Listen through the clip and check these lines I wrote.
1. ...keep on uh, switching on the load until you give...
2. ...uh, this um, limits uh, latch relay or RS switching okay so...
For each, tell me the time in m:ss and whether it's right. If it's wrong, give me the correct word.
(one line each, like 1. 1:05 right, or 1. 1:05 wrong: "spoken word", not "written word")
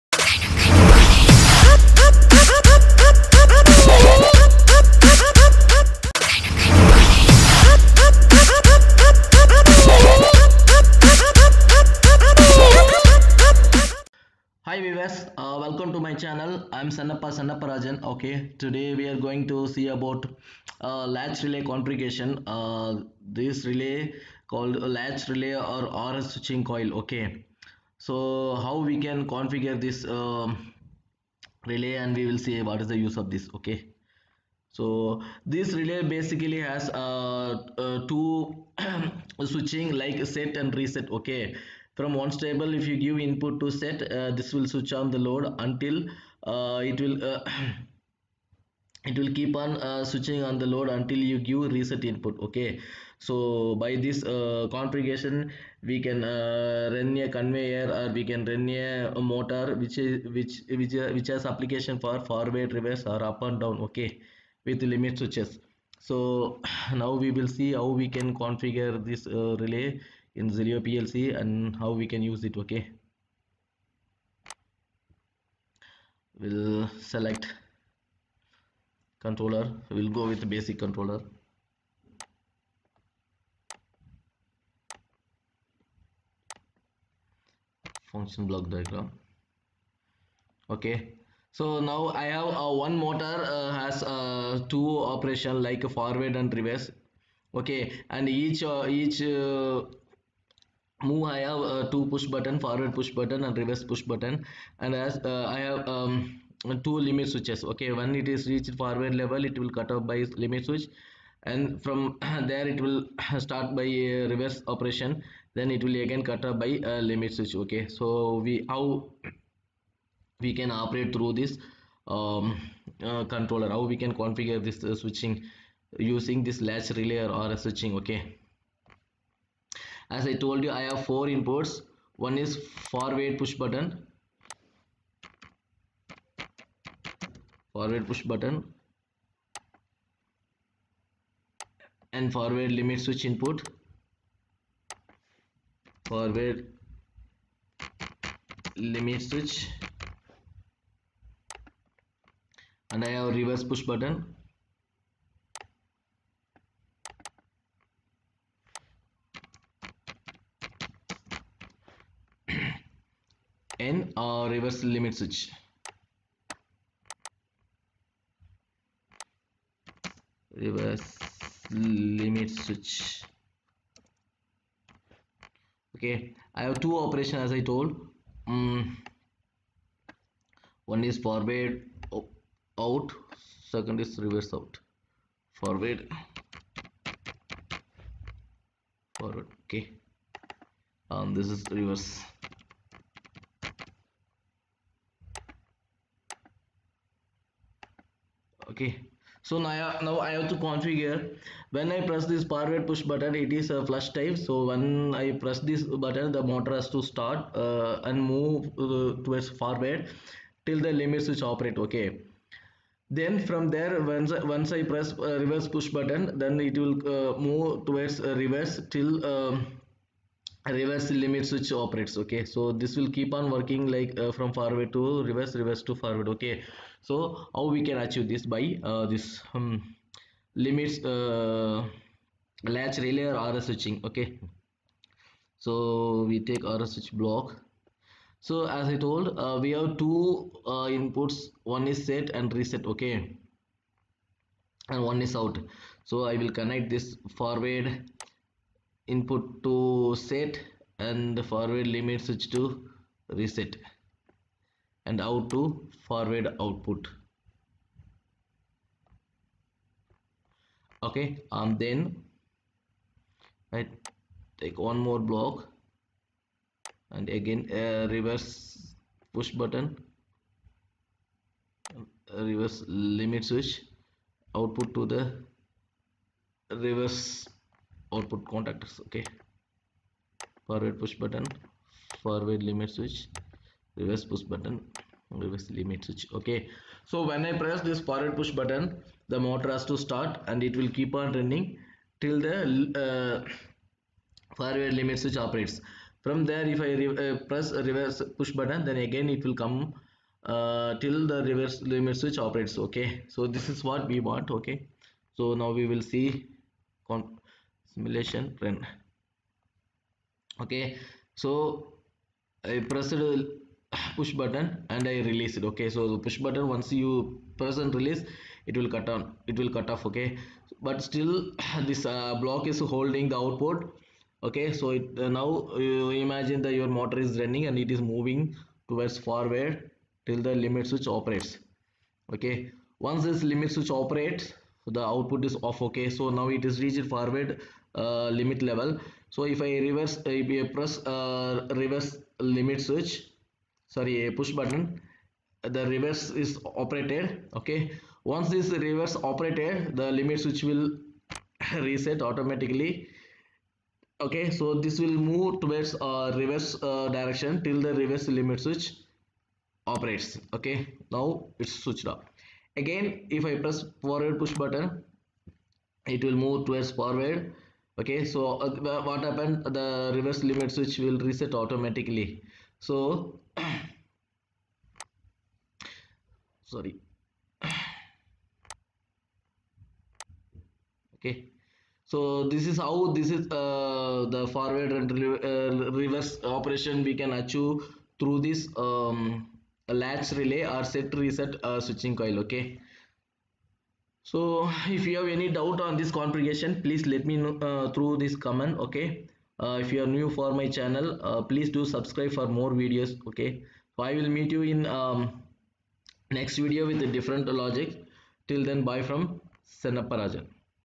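1. 0:49 right
2. 3:48 right.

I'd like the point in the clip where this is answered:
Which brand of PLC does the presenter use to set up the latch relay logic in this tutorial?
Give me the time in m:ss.
1:10.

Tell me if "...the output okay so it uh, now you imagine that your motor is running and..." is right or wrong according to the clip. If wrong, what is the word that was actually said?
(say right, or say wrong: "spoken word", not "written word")
right.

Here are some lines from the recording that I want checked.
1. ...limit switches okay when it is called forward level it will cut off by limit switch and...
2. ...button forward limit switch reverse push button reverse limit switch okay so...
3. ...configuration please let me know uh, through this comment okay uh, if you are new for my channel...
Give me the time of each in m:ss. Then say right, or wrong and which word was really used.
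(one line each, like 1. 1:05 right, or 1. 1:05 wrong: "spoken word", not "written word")
1. 1:46 wrong: "reached", not "called"
2. 4:41 right
3. 6:36 right.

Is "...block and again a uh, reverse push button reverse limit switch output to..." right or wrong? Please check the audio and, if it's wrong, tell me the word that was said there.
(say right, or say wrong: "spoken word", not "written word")
right.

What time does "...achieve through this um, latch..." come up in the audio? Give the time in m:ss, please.
6:27.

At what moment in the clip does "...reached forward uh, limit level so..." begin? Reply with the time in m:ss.
5:36.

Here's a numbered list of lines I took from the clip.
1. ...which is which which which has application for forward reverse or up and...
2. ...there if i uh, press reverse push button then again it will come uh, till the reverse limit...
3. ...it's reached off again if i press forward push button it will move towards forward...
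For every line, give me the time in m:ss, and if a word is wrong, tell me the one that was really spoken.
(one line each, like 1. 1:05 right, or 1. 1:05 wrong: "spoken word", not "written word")
1. 0:59 right
2. 4:56 right
3. 6:01 wrong: "switched", not "reached".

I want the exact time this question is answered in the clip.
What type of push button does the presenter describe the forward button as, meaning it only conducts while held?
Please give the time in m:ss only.
3:23.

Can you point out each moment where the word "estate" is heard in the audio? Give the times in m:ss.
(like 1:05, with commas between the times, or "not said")
not said.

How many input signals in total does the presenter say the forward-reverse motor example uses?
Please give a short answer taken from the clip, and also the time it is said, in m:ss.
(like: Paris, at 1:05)
4, at 2:11.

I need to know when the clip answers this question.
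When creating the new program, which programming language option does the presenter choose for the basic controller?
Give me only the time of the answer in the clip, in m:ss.
1:28.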